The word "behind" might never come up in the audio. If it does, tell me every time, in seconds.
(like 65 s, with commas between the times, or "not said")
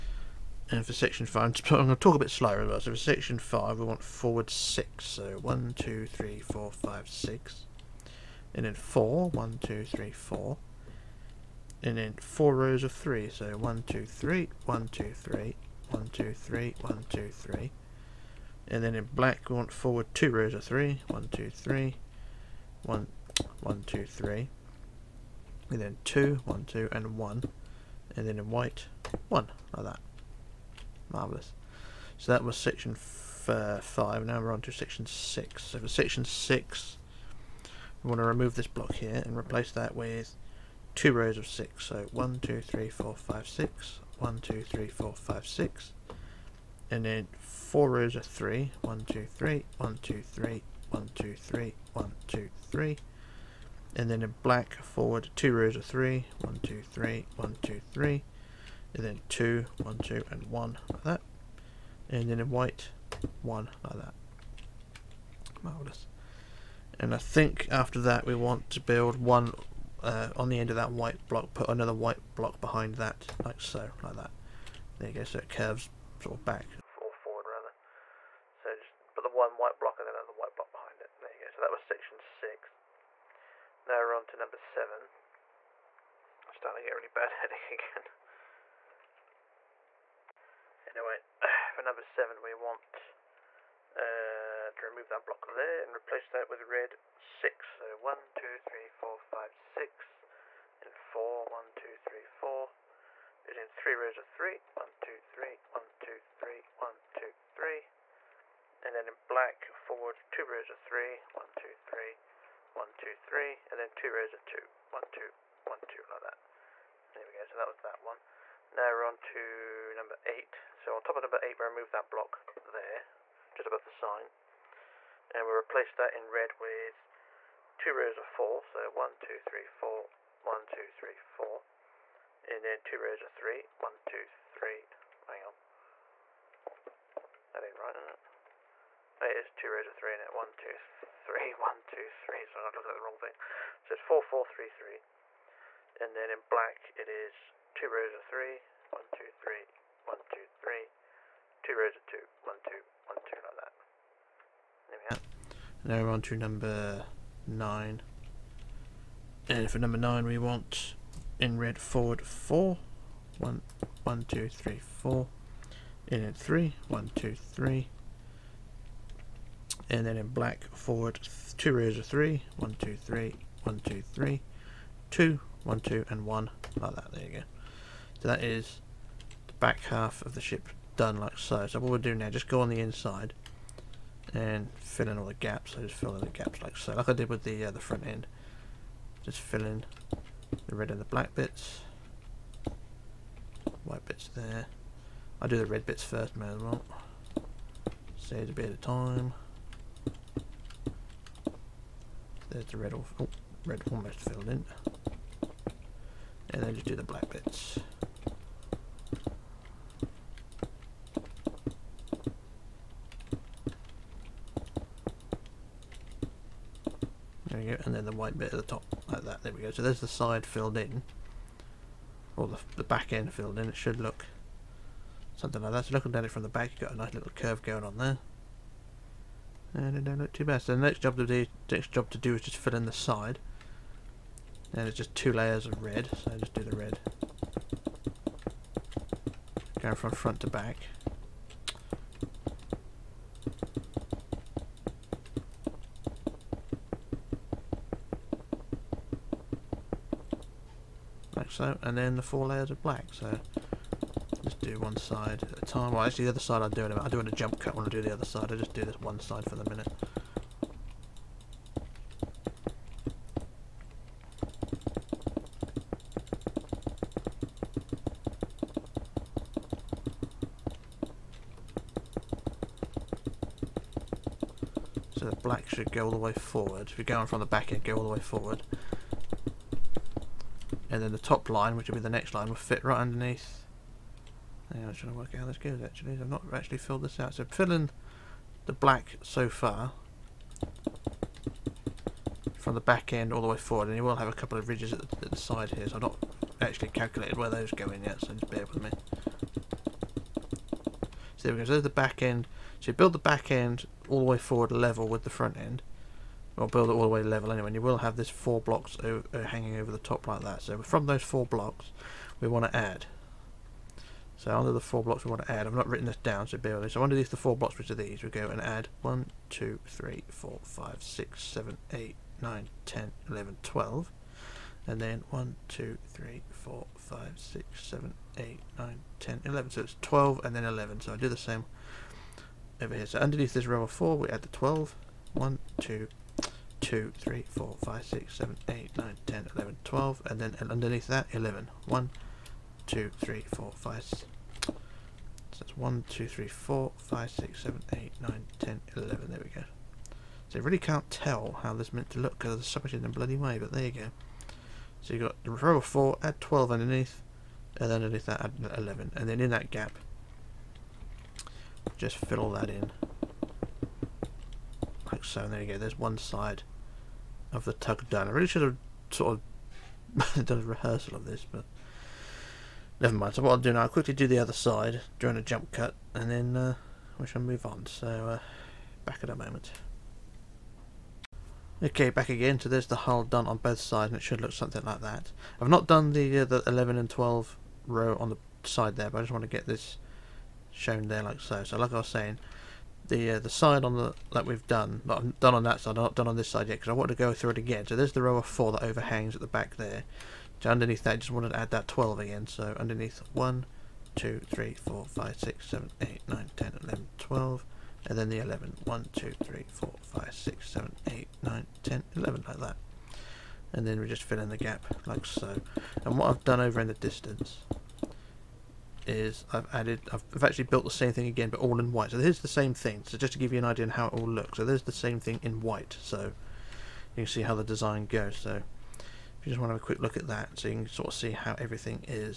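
72 s, 80 s.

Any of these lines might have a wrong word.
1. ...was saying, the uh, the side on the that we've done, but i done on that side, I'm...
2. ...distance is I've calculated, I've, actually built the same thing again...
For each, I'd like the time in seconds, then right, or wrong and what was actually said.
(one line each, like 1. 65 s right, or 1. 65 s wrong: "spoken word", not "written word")
1. 391 s right
2. 416 s wrong: "added", not "calculated".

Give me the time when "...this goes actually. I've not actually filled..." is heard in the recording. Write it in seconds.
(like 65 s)
285 s.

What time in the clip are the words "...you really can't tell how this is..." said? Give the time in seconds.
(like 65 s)
350 s.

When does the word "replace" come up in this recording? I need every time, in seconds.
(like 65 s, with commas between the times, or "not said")
39 s, 95 s, 125 s.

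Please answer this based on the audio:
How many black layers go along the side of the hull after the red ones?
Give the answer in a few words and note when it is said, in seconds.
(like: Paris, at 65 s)
4, at 252 s.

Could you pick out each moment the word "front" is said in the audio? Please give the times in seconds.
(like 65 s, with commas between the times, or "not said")
187 s, 240 s, 305 s.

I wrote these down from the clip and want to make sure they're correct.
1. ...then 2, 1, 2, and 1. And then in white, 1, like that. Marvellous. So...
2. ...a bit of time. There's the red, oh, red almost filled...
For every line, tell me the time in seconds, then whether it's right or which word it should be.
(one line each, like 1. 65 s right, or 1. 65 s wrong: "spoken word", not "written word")
1. 25 s right
2. 198 s right.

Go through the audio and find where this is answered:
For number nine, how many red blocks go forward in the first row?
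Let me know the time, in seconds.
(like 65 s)
160 s.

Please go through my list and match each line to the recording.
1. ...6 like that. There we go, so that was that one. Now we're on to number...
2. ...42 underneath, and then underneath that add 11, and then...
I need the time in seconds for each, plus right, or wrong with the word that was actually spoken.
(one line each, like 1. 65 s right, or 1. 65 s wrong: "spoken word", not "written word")
1. 115 s wrong: "2", not "6"
2. 356 s wrong: "12", not "42".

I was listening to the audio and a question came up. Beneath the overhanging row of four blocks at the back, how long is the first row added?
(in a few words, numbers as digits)
12.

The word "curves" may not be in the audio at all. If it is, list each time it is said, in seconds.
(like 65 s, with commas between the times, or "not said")
75 s, 227 s.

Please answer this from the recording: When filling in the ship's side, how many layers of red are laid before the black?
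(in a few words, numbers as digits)
2.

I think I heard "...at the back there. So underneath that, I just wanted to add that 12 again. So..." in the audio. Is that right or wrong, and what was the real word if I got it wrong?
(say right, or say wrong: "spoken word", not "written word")
right.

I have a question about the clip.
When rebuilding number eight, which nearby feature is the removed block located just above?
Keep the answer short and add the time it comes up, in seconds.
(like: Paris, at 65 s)
the sign, at 123 s.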